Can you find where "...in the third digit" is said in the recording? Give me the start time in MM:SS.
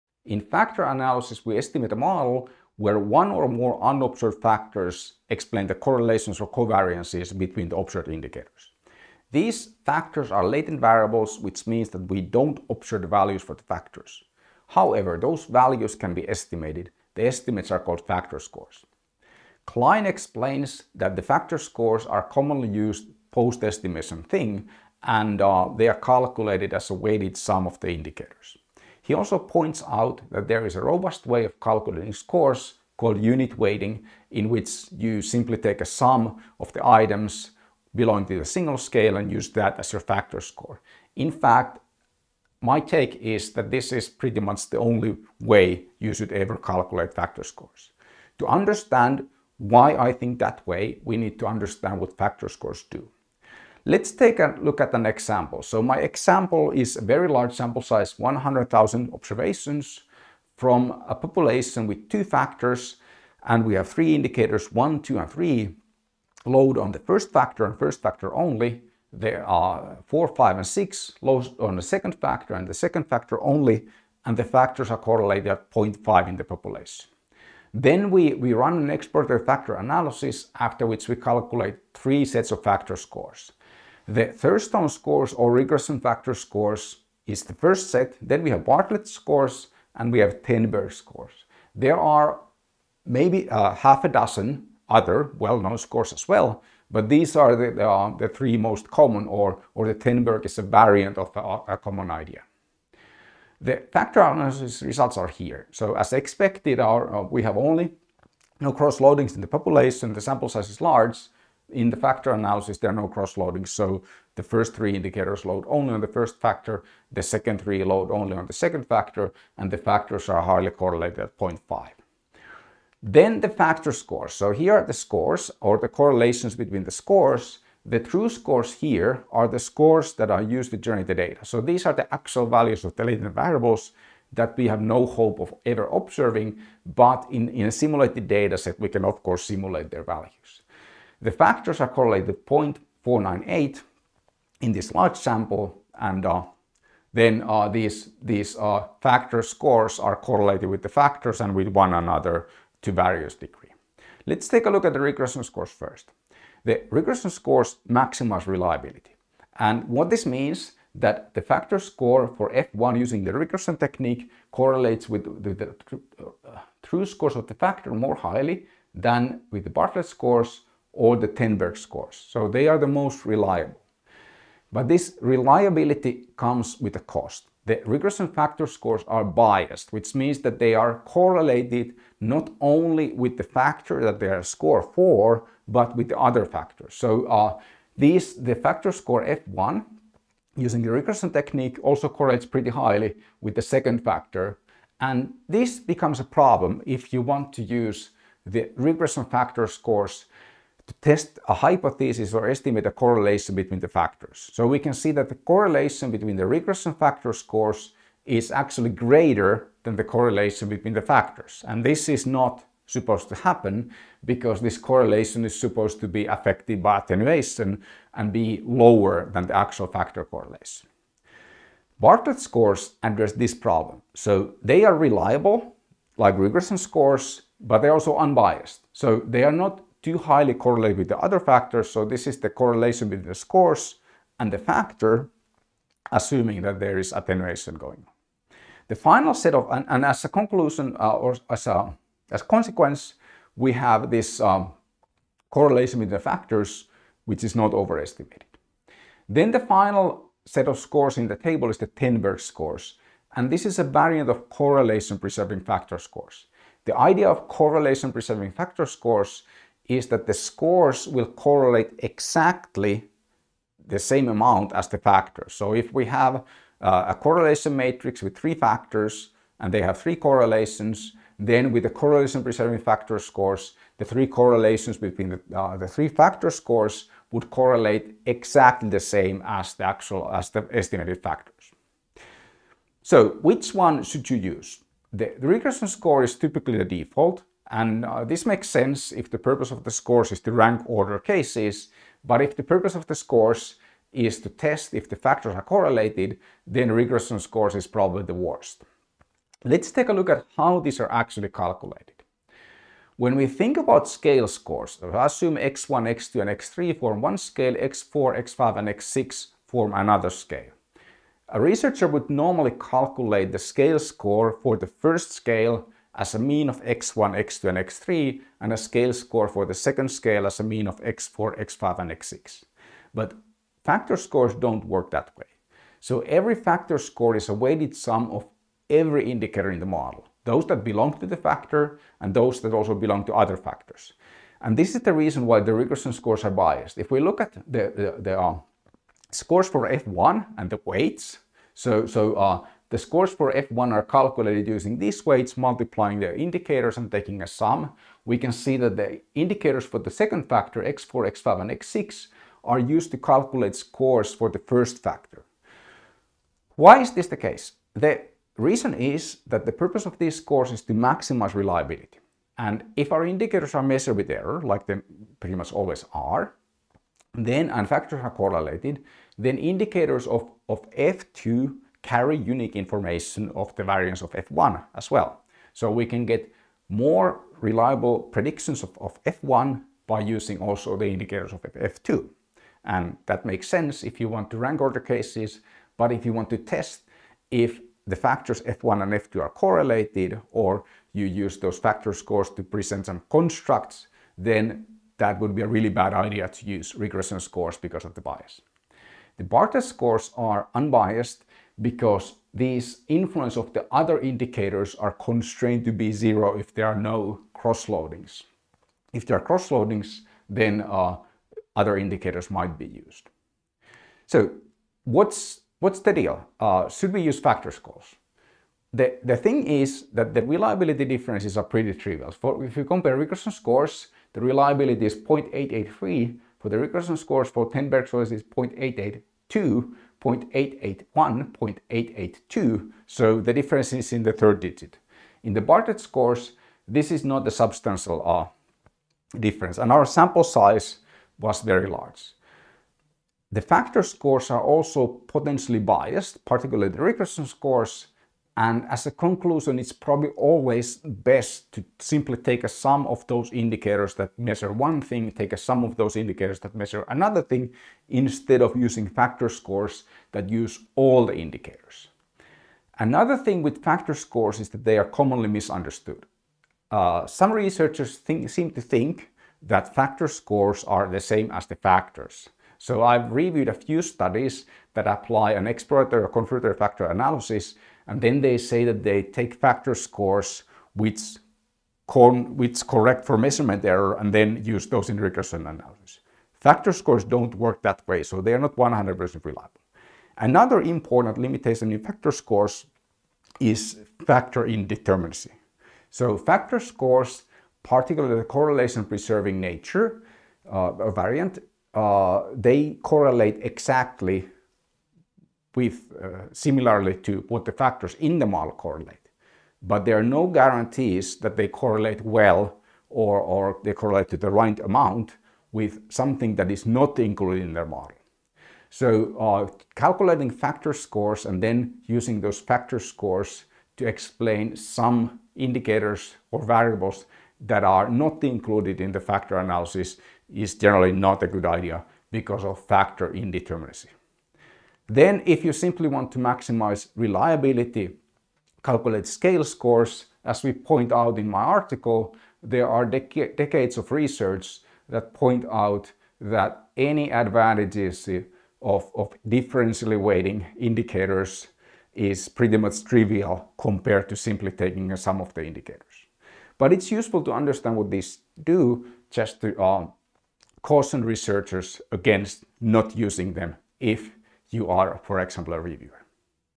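07:14.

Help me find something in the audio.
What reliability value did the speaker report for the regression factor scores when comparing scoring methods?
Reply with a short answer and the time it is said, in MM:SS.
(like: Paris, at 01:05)
0.883, at 07:05.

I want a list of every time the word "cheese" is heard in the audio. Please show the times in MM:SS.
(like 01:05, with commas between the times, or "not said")
not said.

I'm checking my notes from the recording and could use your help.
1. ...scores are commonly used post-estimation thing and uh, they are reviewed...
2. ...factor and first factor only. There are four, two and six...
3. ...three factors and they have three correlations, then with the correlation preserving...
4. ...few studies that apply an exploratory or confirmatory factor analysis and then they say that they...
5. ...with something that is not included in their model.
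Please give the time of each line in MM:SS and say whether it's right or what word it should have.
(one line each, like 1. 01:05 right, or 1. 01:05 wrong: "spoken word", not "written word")
1. 00:21 wrong: "calculated", not "reviewed"
2. 01:07 wrong: "five", not "two"
3. 04:28 right
4. 07:53 right
5. 08:35 right.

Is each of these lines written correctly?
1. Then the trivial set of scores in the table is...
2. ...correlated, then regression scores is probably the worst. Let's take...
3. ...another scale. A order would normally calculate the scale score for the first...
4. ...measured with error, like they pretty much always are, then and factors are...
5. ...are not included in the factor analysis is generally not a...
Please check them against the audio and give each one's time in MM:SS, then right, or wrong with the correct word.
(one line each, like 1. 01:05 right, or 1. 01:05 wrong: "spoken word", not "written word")
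1. 04:09 wrong: "final", not "trivial"
2. 04:55 right
3. 05:09 wrong: "researcher", not "order"
4. 06:03 right
5. 08:47 right.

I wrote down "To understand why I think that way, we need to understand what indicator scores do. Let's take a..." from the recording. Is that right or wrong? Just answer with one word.
wrong.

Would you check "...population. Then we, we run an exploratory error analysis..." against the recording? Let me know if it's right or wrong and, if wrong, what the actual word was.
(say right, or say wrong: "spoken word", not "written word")
wrong: "factor", not "error".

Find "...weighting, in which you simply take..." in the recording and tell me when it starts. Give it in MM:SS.
00:33.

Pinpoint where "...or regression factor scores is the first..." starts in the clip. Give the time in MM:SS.
01:25.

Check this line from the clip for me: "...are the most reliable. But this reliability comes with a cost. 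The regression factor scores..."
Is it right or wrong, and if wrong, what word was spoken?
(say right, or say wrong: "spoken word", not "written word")
right.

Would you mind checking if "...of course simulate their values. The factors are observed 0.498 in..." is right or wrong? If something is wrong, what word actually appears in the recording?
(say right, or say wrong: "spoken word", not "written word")
wrong: "correlated", not "observed".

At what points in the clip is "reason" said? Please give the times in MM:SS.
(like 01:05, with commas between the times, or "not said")
05:35, 05:58.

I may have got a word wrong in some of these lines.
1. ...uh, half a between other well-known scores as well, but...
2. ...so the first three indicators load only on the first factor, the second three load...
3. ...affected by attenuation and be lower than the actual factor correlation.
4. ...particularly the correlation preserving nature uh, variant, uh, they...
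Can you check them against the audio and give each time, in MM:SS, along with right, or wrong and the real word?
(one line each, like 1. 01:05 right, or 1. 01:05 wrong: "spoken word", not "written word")
1. 01:33 wrong: "dozen", not "between"
2. 01:53 right
3. 03:36 right
4. 08:17 right.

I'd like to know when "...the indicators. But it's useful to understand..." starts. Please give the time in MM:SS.
09:15.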